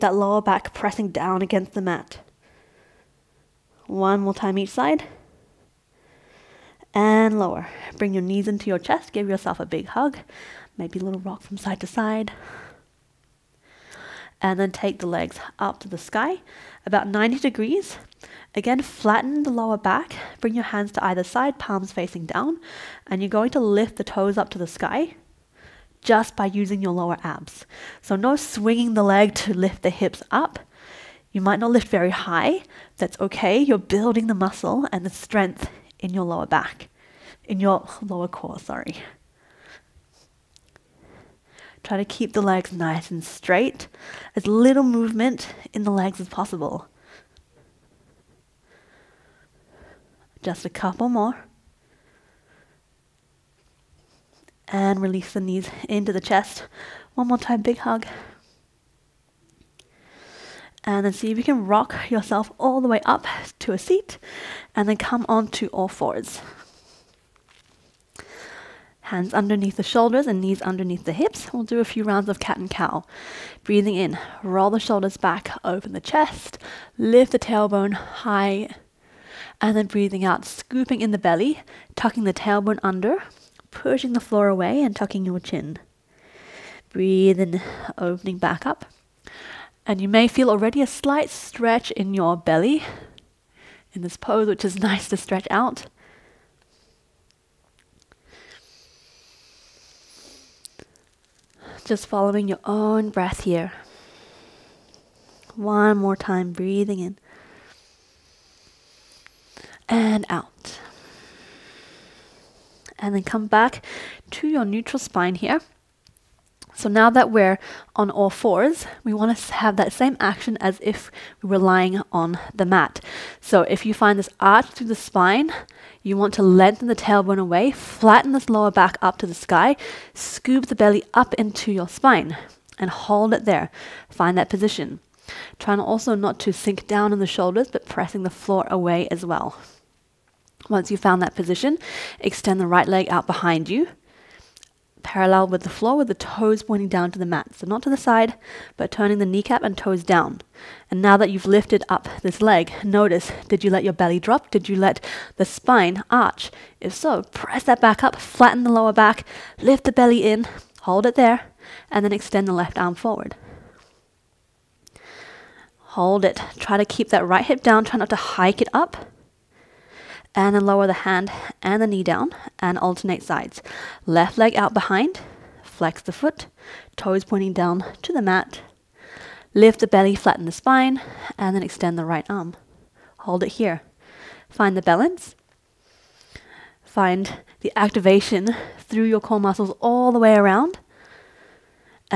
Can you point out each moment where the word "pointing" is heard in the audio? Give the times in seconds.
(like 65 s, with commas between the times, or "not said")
146 s, 177 s.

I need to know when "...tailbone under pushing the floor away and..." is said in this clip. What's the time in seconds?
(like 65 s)
82 s.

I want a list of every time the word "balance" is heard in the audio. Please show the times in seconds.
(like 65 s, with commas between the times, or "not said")
184 s.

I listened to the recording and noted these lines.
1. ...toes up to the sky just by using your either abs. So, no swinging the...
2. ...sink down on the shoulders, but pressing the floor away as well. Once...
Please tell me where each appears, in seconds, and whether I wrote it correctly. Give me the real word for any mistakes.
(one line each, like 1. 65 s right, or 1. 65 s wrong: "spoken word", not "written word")
1. 24 s wrong: "lower", not "either"
2. 136 s right.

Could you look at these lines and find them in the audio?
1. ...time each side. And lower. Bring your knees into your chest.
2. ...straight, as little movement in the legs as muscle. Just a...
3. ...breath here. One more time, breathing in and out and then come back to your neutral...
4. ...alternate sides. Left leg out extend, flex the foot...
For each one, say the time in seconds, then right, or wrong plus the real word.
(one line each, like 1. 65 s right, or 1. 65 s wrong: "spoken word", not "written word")
1. 4 s right
2. 43 s wrong: "possible", not "muscle"
3. 103 s right
4. 172 s wrong: "behind", not "extend".